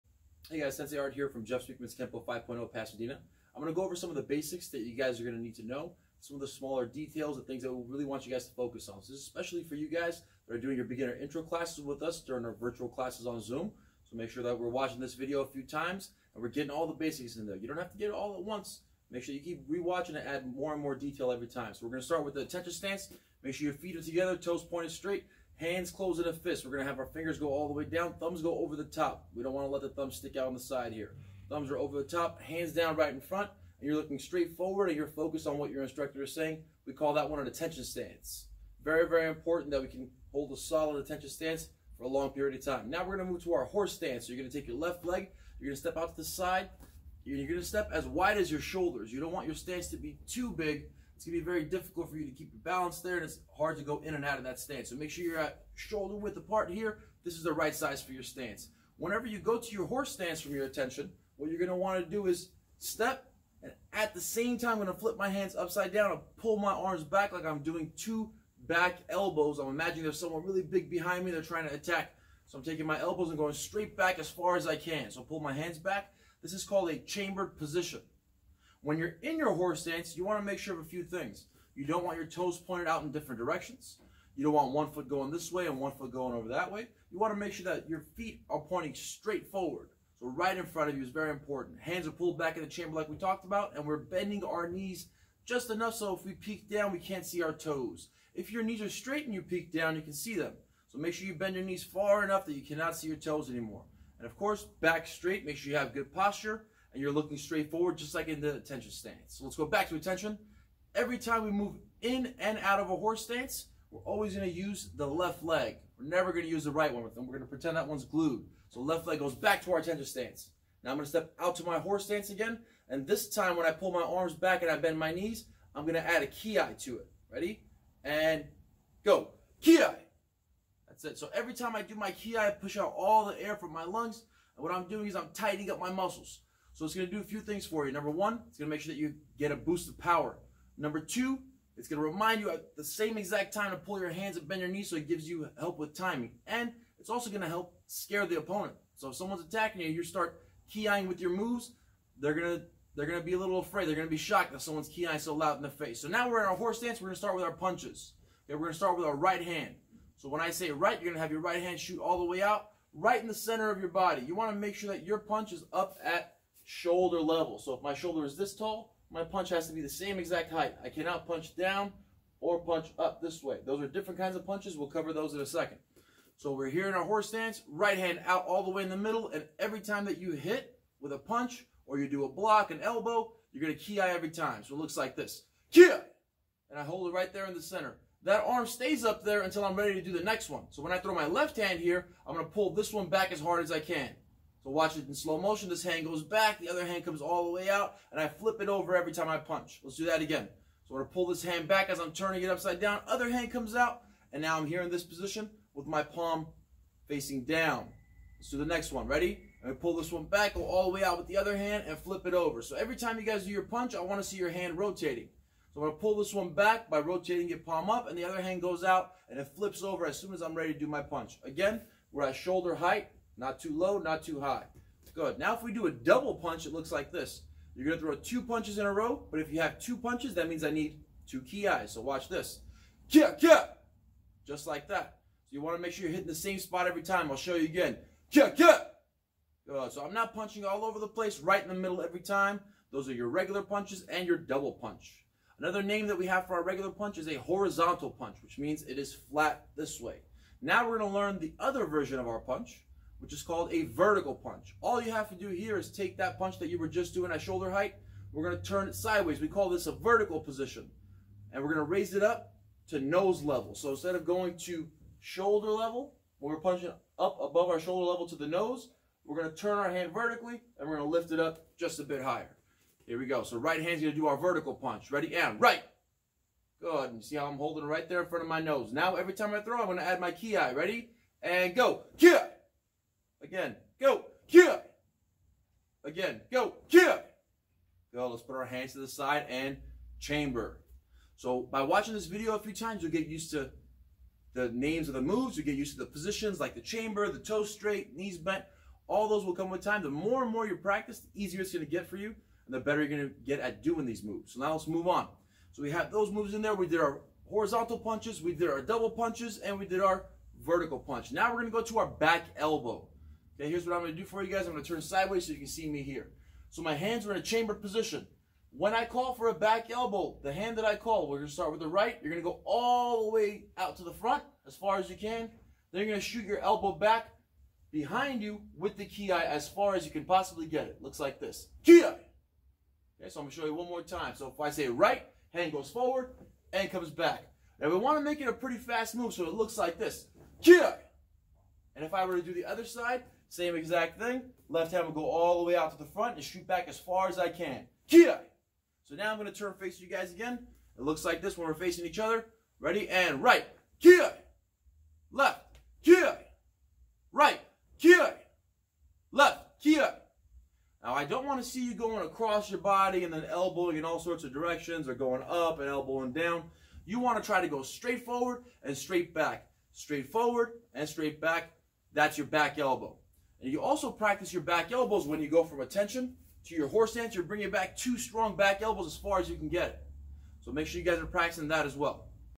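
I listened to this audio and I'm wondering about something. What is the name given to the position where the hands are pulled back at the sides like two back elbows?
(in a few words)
Chambered position.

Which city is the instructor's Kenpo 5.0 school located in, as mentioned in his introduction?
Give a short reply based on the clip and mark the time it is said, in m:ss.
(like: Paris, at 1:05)
Pasadena, at 0:02.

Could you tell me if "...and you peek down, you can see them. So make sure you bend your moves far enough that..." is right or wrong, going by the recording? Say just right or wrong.
wrong.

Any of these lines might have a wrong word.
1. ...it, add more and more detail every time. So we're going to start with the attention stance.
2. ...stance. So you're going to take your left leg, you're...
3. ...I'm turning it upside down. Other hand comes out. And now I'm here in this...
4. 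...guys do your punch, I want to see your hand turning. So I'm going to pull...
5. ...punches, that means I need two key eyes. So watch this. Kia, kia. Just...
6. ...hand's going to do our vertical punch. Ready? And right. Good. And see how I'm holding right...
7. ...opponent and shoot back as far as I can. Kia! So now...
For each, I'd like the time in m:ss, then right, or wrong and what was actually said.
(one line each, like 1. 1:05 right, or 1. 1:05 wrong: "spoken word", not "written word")
1. 0:20 right
2. 0:43 right
3. 3:21 right
4. 3:33 wrong: "rotating", not "turning"
5. 3:49 right
6. 4:33 right
7. 5:46 wrong: "front", not "opponent".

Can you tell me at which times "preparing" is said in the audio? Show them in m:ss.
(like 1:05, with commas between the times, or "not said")
not said.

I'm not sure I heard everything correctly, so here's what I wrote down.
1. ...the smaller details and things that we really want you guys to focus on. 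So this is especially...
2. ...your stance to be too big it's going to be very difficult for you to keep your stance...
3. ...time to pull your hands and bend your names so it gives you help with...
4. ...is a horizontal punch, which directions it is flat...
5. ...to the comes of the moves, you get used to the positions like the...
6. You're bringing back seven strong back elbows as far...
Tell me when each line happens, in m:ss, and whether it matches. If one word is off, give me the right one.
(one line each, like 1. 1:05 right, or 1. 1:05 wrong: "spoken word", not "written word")
1. 0:06 right
2. 0:49 wrong: "balance", not "stance"
3. 2:23 wrong: "knees", not "names"
4. 4:07 wrong: "means", not "directions"
5. 4:53 wrong: "names", not "comes"
6. 6:17 wrong: "two", not "seven".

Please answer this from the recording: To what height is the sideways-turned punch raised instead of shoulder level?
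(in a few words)
Nose level.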